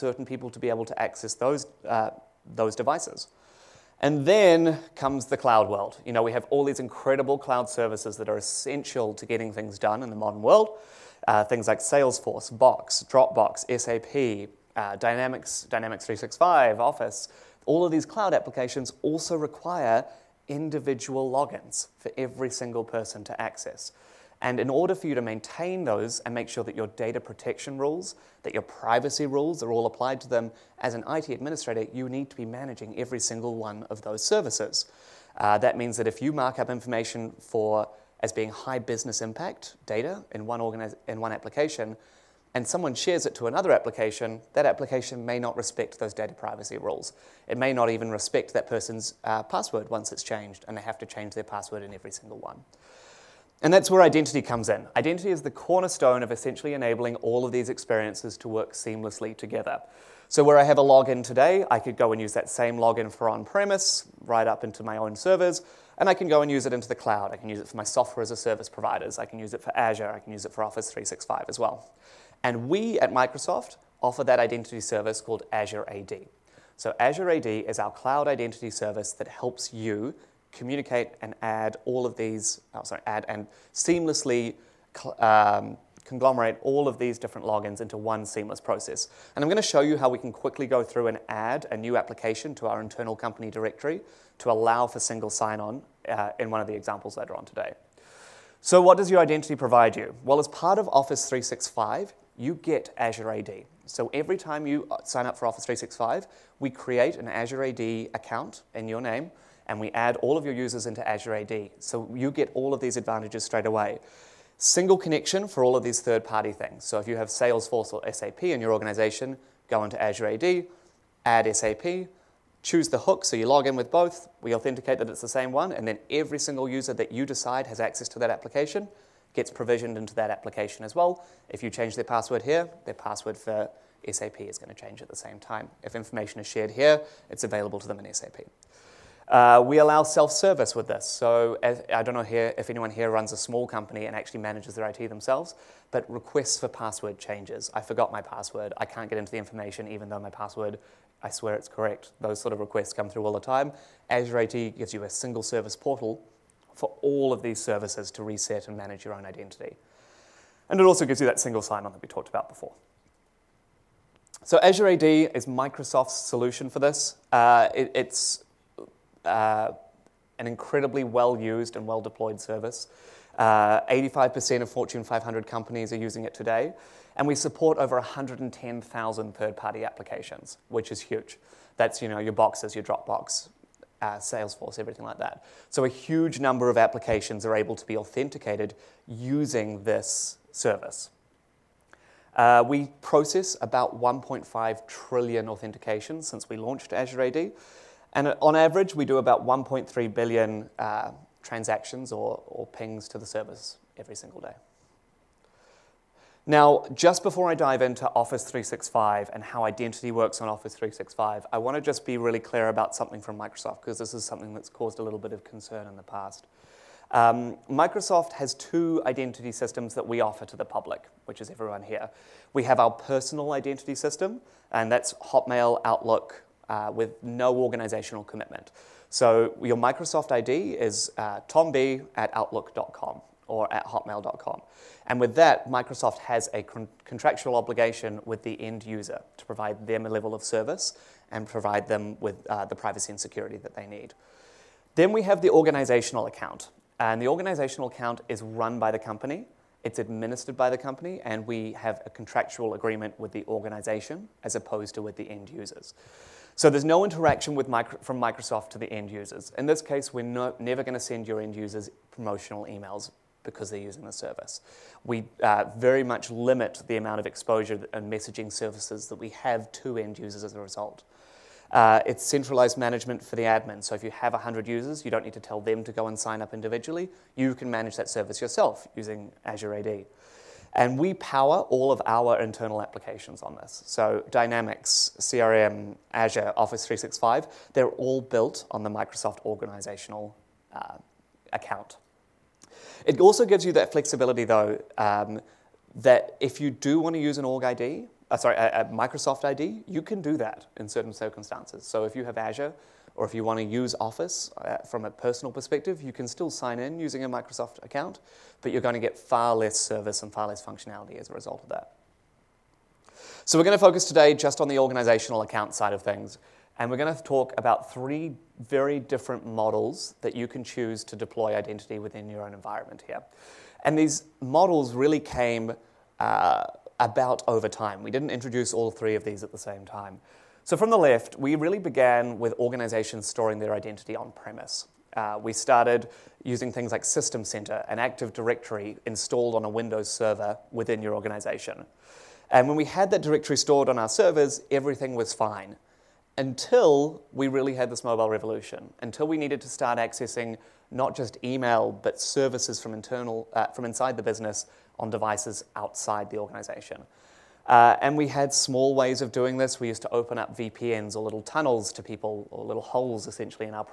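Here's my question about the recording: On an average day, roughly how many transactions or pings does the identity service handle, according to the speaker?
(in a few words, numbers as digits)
1.3 billion.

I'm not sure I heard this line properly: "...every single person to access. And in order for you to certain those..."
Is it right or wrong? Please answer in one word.
wrong.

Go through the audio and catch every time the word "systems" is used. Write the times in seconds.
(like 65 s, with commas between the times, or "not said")
219 s, 223 s, 337 s.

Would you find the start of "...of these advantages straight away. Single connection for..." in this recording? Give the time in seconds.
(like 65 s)
112 s.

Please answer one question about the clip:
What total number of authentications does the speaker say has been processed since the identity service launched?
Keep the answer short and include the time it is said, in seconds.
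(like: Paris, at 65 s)
1.5 trillion, at 193 s.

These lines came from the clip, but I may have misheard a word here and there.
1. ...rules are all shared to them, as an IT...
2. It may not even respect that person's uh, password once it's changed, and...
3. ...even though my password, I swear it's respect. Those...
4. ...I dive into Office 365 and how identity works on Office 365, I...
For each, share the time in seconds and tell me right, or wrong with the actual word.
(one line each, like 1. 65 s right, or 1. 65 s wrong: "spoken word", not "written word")
1. 29 s wrong: "applied", not "shared"
2. 47 s right
3. 149 s wrong: "correct", not "respect"
4. 207 s right.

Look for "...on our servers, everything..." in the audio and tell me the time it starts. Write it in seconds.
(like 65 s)
343 s.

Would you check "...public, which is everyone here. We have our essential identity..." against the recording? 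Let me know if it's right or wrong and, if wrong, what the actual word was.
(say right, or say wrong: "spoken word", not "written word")
wrong: "personal", not "essential".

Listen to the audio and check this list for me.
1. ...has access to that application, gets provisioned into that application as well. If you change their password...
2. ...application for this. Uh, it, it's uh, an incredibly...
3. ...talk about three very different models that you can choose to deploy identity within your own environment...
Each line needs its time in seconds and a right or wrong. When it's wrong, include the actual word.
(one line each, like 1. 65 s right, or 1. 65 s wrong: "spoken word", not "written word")
1. 127 s right
2. 166 s wrong: "solution", not "application"
3. 317 s right.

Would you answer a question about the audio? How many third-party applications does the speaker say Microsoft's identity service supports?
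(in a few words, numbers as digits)
110,000.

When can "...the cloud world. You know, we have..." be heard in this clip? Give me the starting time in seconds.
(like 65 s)
5 s.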